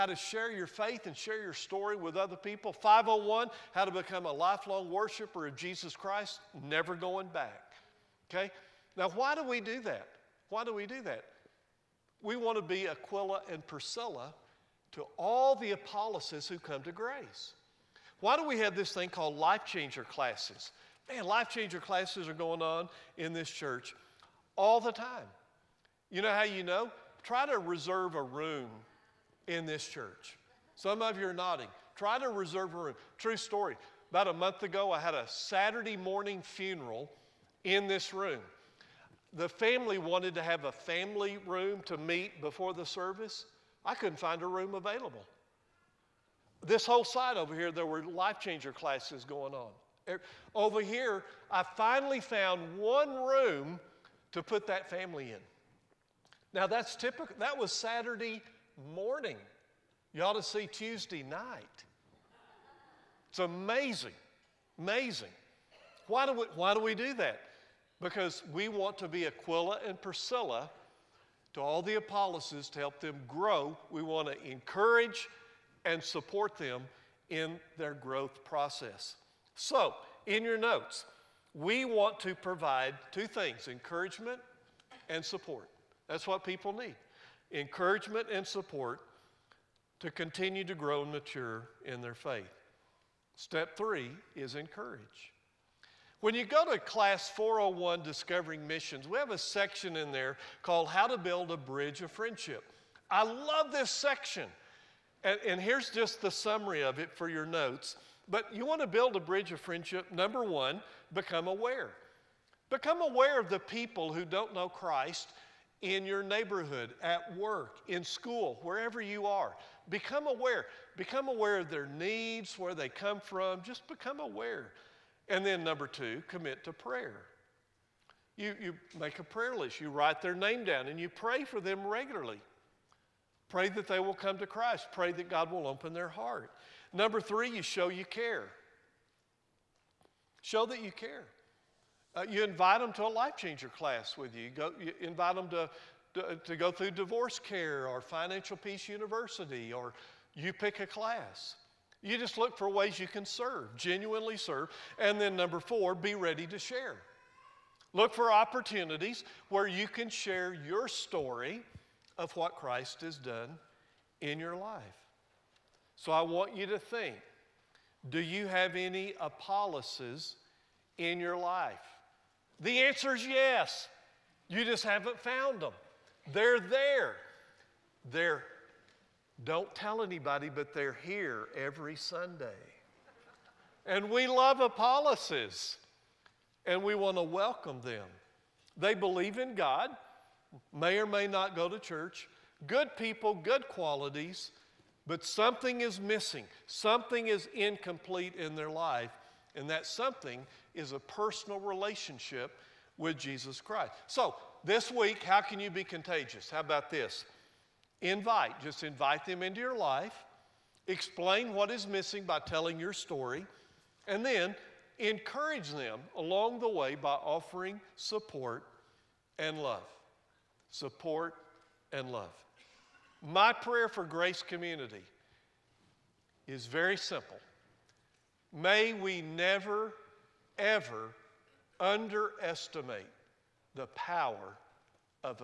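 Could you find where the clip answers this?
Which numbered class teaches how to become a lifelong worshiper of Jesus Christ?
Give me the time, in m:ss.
0:02.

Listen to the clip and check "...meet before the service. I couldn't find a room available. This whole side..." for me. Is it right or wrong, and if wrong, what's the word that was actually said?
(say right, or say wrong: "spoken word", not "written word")
right.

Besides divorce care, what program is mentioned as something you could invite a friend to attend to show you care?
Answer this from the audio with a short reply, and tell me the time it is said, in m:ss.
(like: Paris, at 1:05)
Financial Peace University, at 2:27.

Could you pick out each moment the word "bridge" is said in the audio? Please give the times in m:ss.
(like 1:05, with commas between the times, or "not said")
1:41, 1:49.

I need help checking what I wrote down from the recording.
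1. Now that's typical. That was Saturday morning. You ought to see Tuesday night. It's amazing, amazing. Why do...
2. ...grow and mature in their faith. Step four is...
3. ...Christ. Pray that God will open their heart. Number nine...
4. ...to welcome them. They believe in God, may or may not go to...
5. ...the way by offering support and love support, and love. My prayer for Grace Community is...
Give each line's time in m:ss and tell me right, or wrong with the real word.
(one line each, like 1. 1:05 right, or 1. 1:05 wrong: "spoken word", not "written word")
1. 0:56 right
2. 1:30 wrong: "three", not "four"
3. 2:14 wrong: "three", not "nine"
4. 3:07 right
5. 3:36 right.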